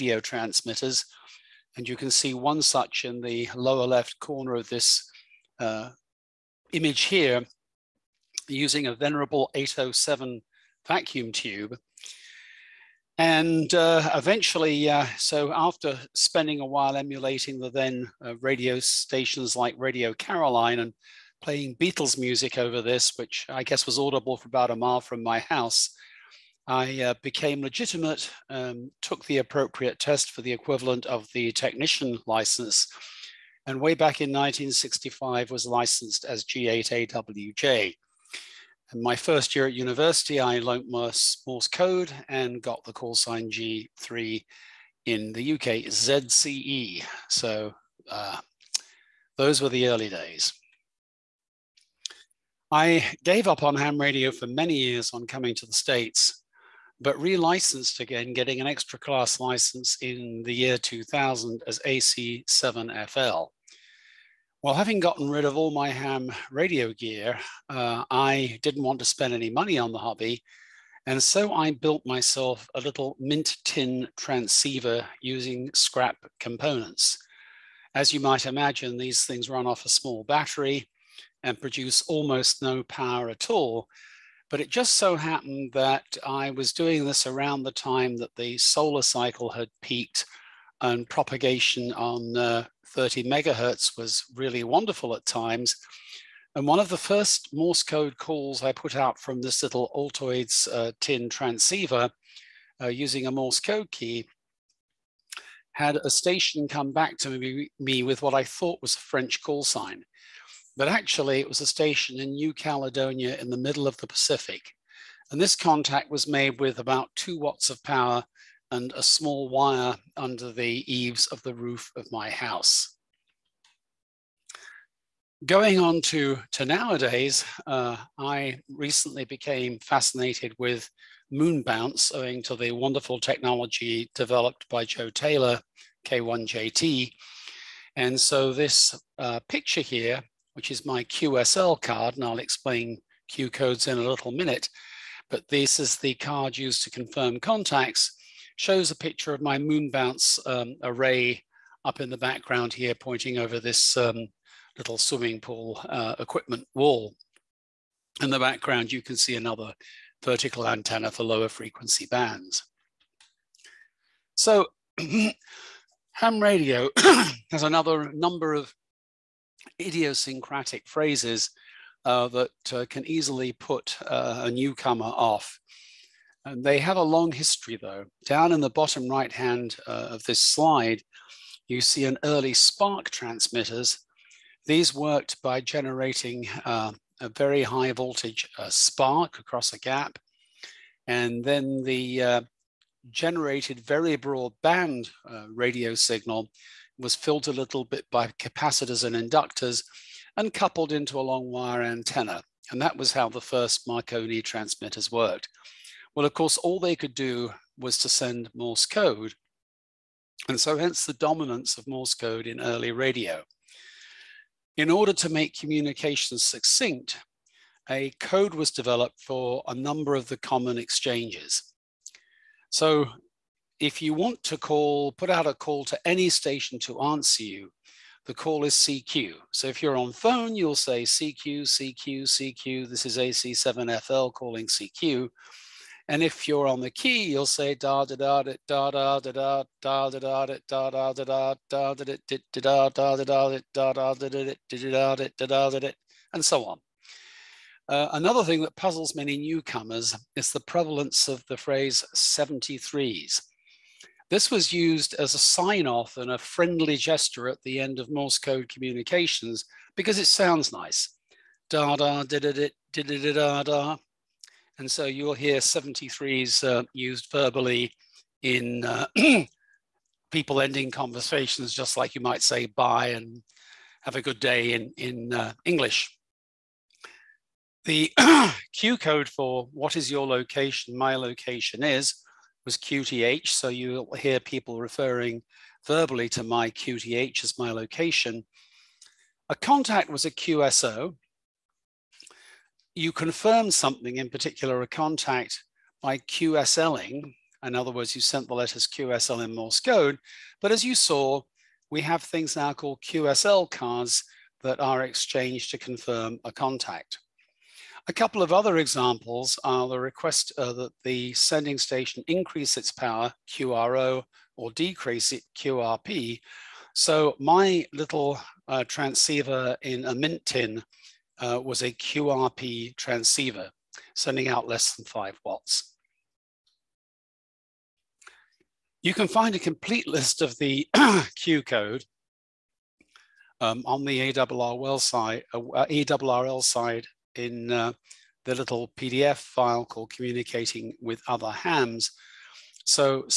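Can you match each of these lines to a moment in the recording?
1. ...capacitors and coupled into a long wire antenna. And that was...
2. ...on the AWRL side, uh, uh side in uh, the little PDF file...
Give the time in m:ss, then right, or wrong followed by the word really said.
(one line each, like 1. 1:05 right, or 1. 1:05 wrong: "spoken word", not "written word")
1. 3:19 wrong: "inductors", not "capacitors"
2. 5:33 right.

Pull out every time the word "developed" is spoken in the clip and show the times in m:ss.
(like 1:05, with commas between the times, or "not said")
2:14, 3:38.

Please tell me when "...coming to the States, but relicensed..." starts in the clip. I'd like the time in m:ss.
0:55.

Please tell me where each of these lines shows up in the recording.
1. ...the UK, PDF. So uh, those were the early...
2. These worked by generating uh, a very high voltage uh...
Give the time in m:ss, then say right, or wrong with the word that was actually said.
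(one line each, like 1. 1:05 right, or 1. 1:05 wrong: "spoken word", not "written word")
1. 0:45 wrong: "ZCE", not "PDF"
2. 3:04 right.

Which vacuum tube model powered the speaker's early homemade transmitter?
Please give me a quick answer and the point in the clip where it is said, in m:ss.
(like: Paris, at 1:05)
807, at 0:09.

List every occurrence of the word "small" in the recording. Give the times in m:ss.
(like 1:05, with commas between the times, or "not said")
1:19, 1:59.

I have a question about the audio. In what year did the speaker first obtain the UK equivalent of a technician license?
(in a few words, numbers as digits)
1965.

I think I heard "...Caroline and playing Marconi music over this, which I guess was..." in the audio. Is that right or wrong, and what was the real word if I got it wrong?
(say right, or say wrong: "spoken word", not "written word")
wrong: "Beatles", not "Marconi".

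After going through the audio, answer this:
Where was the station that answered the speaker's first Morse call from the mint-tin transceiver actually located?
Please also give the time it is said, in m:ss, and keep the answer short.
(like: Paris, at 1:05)
New Caledonia, at 1:52.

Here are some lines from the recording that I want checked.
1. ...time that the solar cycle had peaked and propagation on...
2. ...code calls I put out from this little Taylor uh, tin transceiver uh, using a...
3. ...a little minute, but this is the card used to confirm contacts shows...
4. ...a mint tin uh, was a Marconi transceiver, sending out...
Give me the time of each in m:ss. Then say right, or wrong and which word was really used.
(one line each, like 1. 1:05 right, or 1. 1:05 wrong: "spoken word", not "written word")
1. 1:27 right
2. 1:37 wrong: "Altoids", not "Taylor"
3. 2:23 right
4. 5:20 wrong: "QRP", not "Marconi".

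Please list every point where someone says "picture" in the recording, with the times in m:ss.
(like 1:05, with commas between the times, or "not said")
2:19, 2:28.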